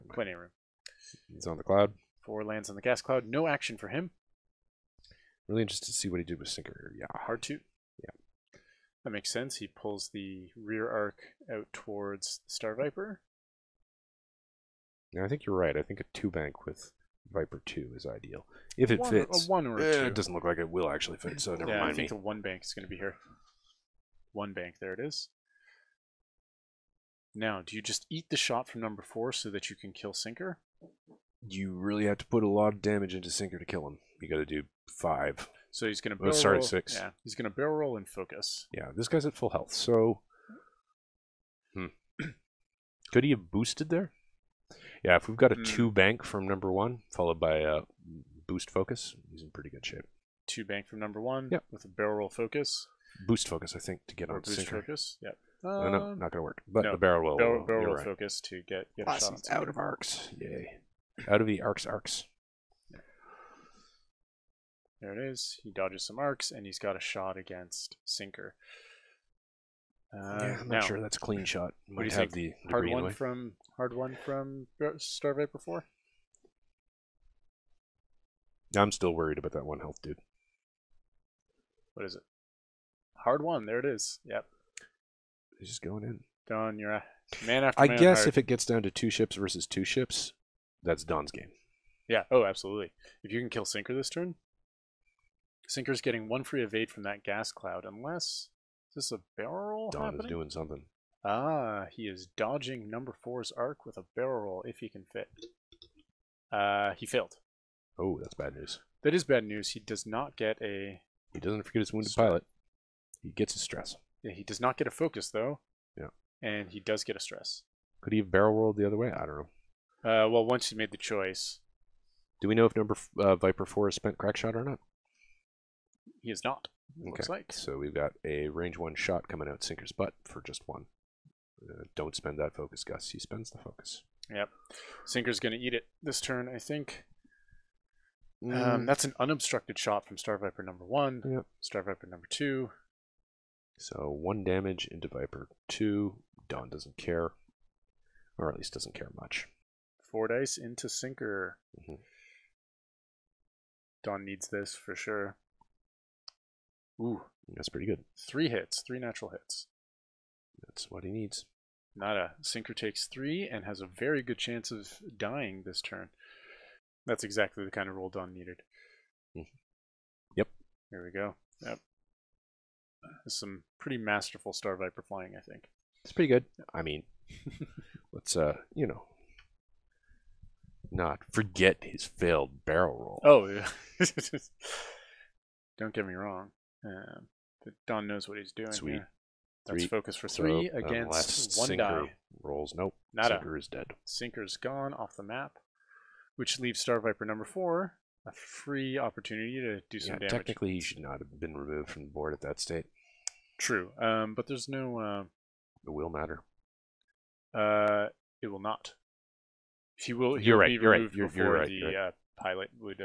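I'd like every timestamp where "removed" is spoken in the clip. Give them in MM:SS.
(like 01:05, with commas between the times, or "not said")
03:21.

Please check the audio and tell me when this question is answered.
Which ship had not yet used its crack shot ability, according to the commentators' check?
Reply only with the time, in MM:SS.
02:03.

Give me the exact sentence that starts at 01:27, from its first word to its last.
I man guess if it gets down to two ships versus two ships, that's Don's game.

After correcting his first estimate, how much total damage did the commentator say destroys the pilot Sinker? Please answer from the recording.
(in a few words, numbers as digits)
6.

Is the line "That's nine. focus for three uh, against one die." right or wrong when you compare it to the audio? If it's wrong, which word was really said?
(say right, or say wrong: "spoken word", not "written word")
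wrong: "three", not "nine".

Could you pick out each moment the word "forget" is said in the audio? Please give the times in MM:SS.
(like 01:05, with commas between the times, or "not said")
01:51, 03:01.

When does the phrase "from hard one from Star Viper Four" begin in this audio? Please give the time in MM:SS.
01:13.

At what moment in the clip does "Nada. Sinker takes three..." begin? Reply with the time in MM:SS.
02:41.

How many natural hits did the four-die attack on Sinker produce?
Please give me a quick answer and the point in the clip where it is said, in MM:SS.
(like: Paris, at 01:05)
3, at 02:38.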